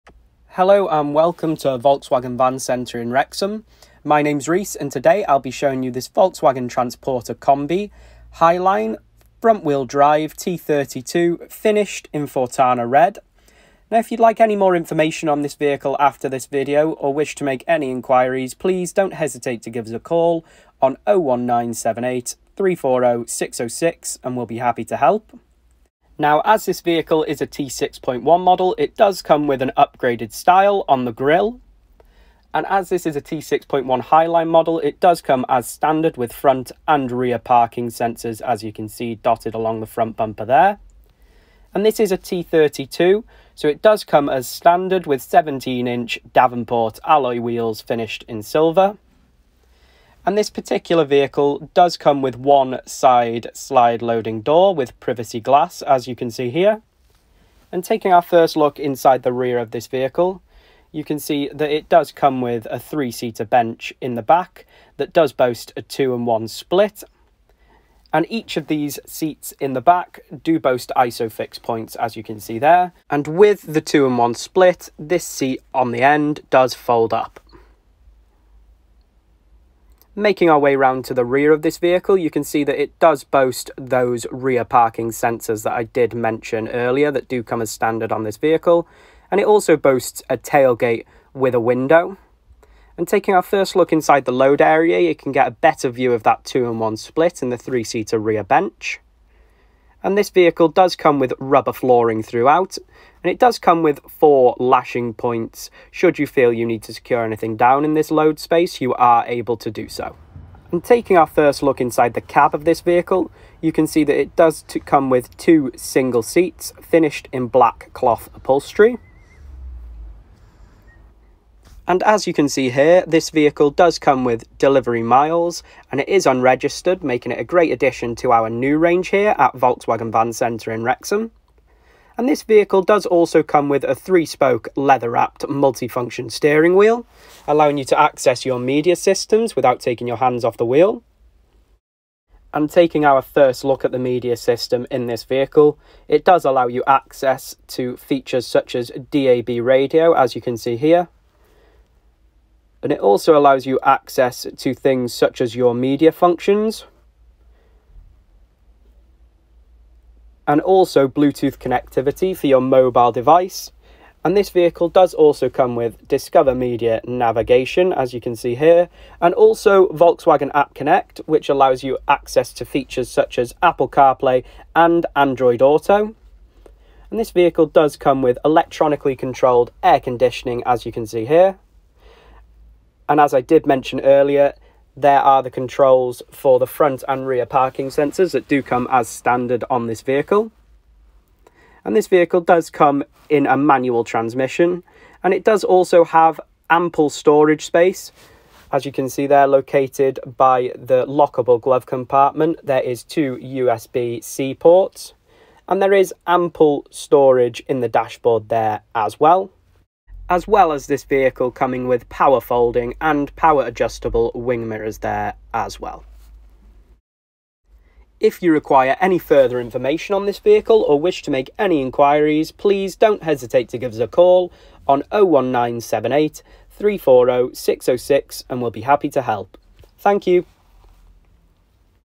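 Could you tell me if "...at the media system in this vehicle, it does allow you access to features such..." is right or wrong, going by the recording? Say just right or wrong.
right.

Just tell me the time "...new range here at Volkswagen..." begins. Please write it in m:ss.
2:08.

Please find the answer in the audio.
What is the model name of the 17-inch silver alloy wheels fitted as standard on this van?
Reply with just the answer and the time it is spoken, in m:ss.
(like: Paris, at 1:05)
Davenport, at 0:46.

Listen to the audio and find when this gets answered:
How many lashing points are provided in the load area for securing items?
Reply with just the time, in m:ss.
1:44.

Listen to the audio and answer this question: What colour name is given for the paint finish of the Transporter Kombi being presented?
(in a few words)
Fortana Red.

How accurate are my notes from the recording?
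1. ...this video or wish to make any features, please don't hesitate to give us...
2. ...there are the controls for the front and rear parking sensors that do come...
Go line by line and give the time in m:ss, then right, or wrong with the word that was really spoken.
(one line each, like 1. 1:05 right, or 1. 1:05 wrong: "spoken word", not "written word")
1. 0:16 wrong: "inquiries", not "features"
2. 3:04 right.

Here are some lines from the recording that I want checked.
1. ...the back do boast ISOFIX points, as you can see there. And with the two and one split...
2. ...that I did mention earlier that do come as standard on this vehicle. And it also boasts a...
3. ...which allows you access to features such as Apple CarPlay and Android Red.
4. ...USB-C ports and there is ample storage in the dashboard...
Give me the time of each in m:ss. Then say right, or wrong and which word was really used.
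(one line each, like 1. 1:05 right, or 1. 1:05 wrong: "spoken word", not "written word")
1. 1:09 right
2. 1:25 right
3. 2:51 wrong: "Auto", not "Red"
4. 3:23 right.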